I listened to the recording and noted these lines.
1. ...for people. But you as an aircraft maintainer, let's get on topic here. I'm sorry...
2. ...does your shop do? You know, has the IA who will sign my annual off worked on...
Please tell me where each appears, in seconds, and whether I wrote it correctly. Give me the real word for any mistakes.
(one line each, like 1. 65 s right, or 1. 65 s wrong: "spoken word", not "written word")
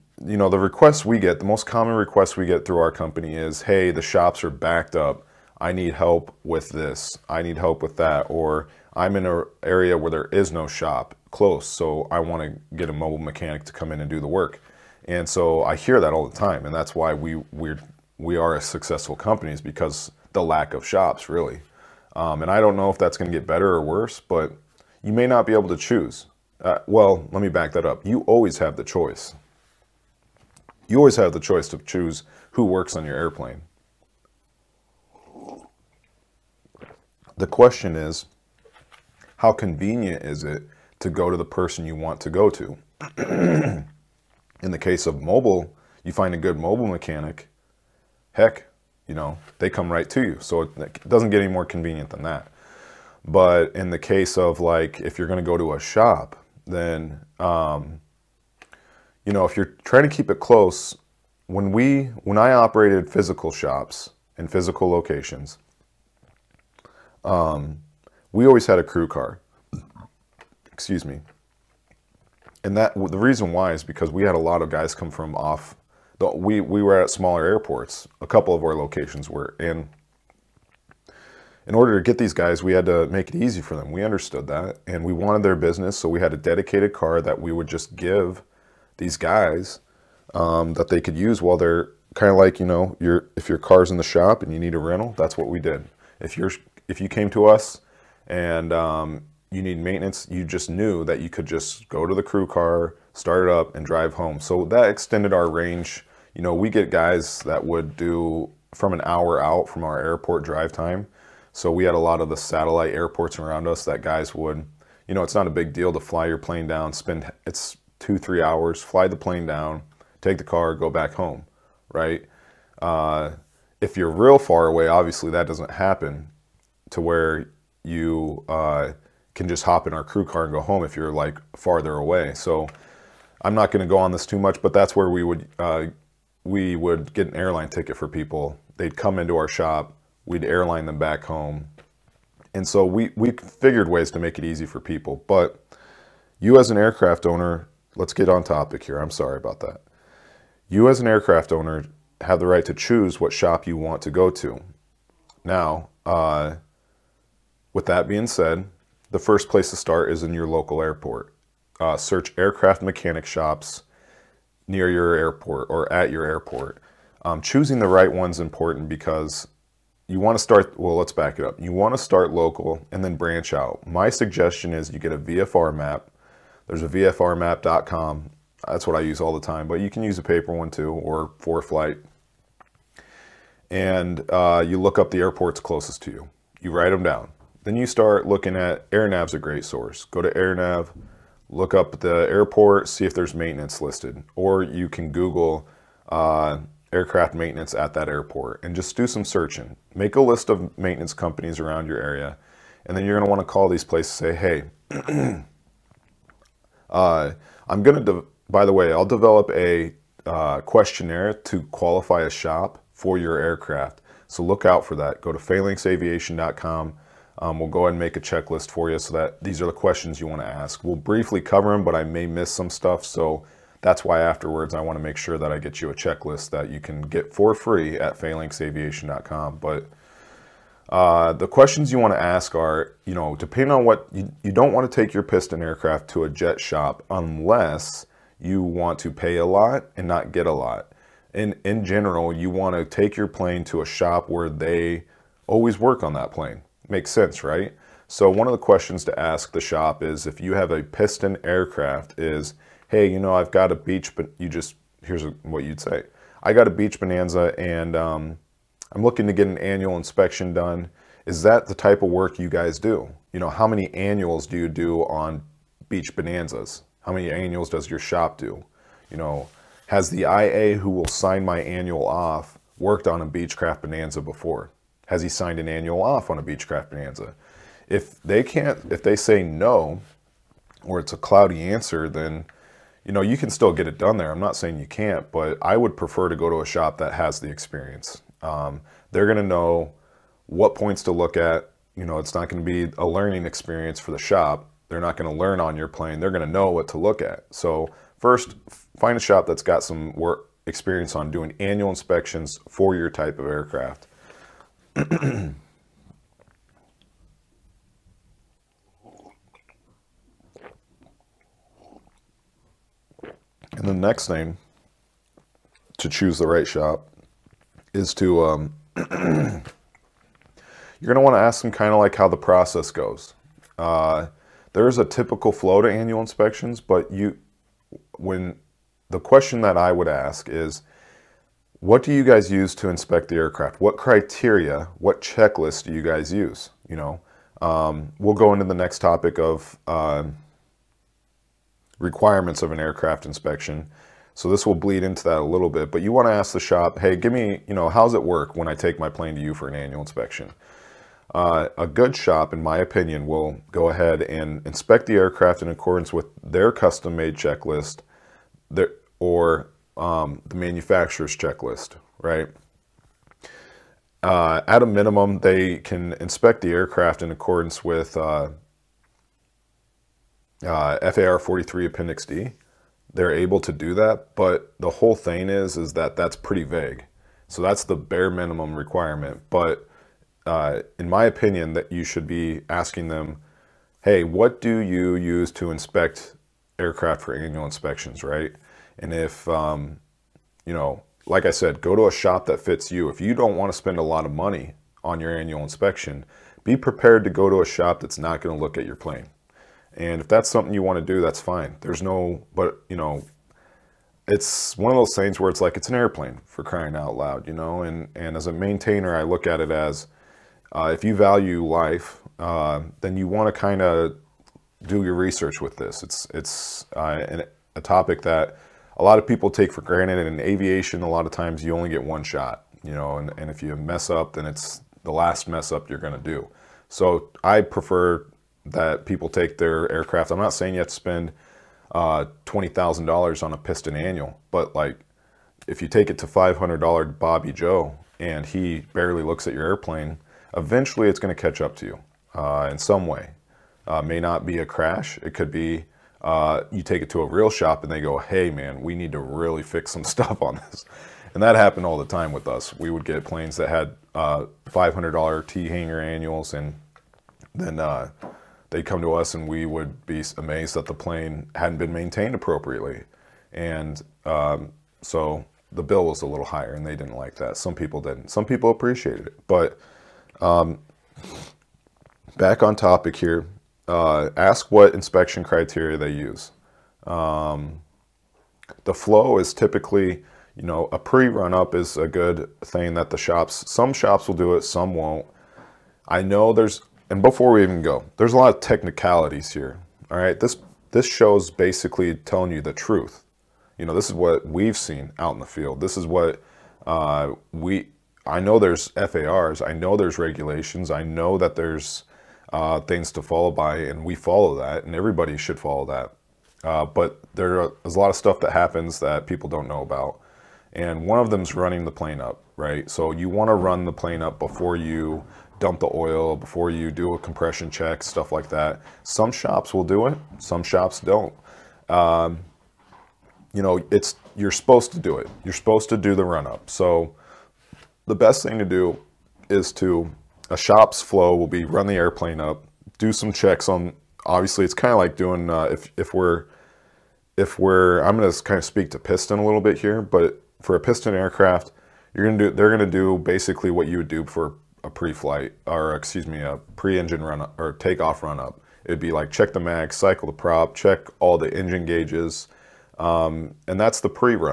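1. 144 s wrong: "owner", not "maintainer"
2. 267 s right.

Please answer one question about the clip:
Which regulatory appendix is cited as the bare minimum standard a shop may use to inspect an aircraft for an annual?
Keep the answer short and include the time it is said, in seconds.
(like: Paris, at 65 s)
FAR 43 Appendix D, at 371 s.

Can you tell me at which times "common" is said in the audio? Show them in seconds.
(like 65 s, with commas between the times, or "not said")
1 s.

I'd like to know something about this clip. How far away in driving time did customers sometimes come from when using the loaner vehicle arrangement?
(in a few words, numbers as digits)
an hour.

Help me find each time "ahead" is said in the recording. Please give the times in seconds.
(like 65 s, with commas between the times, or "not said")
217 s, 353 s.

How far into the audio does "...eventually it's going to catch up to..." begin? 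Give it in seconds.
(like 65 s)
440 s.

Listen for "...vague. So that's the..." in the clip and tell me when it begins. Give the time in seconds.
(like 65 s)
376 s.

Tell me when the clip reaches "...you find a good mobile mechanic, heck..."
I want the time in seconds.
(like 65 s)
46 s.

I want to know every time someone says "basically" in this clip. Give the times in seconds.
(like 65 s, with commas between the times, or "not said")
491 s, 543 s.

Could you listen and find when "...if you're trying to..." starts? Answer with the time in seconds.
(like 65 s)
59 s.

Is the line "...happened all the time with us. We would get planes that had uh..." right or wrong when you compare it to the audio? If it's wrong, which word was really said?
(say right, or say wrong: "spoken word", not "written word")
right.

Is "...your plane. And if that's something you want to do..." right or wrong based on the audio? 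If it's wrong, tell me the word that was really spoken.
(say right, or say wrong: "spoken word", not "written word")
right.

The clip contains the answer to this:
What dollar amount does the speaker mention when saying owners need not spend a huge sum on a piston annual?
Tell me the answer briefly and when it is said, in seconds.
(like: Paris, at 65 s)
$20,000, at 432 s.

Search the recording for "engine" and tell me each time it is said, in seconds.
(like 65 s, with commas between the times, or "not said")
546 s, 551 s.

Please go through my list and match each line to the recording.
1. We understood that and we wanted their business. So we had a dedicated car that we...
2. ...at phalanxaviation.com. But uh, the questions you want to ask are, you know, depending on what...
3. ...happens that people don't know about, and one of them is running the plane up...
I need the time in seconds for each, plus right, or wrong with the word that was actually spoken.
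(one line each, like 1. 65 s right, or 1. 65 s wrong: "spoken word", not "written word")
1. 83 s right
2. 227 s right
3. 508 s right.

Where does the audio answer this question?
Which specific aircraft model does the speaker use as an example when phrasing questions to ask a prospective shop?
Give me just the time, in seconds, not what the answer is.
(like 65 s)
256 s.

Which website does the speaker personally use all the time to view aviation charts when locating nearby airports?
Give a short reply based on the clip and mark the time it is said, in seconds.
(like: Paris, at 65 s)
VFRmap.com, at 176 s.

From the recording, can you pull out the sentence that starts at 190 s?
Go to AirNav, look up the airport, see if there's maintenance listed.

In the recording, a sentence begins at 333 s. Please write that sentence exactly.
What criteria, what checklist do you guys use?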